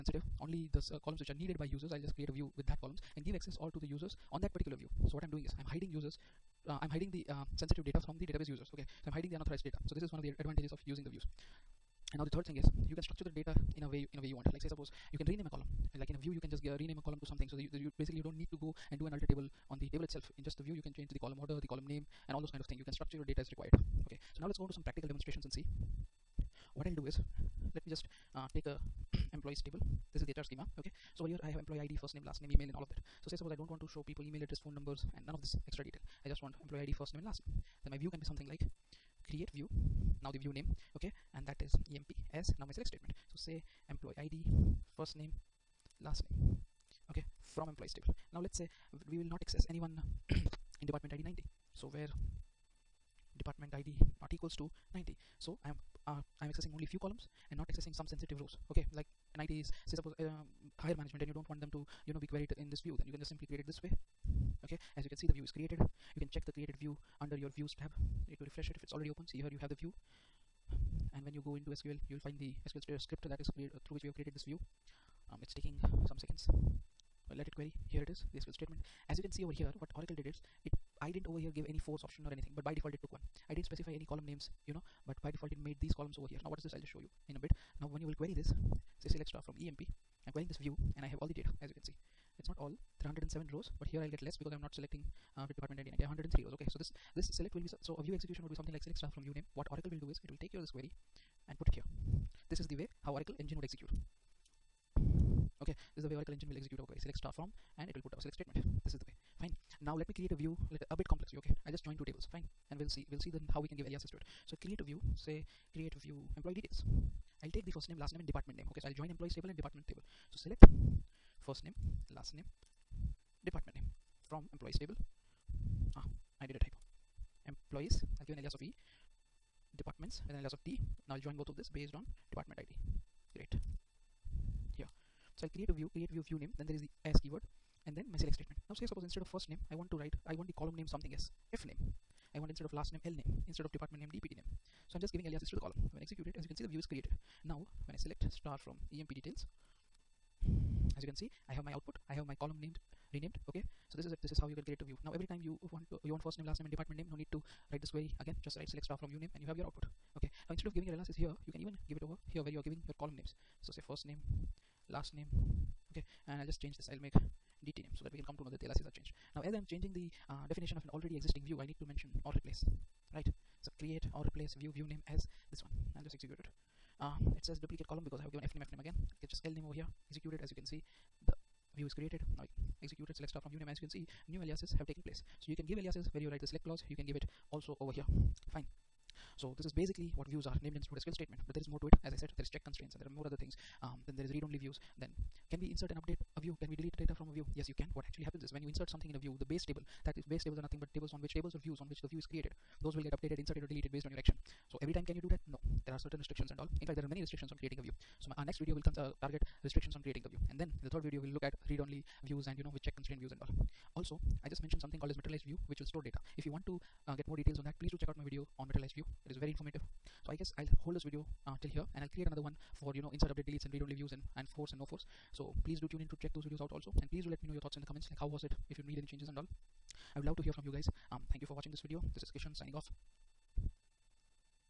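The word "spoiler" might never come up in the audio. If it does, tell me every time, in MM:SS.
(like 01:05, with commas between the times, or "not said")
not said.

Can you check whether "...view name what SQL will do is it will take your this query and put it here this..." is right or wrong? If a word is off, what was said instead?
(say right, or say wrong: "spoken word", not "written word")
wrong: "Oracle", not "SQL".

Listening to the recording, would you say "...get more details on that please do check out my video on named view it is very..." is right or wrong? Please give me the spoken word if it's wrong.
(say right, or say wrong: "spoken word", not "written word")
wrong: "materialized", not "named".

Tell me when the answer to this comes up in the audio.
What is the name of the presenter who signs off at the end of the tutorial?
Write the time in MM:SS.
03:52.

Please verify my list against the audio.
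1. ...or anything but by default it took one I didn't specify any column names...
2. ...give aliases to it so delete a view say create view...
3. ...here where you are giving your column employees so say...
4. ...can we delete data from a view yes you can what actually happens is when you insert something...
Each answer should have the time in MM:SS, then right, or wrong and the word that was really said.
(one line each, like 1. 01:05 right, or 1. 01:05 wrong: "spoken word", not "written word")
1. 01:22 right
2. 01:53 wrong: "create", not "delete"
3. 02:42 wrong: "names", not "employees"
4. 03:16 right.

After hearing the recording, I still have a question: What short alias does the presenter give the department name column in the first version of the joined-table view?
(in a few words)
DPT name.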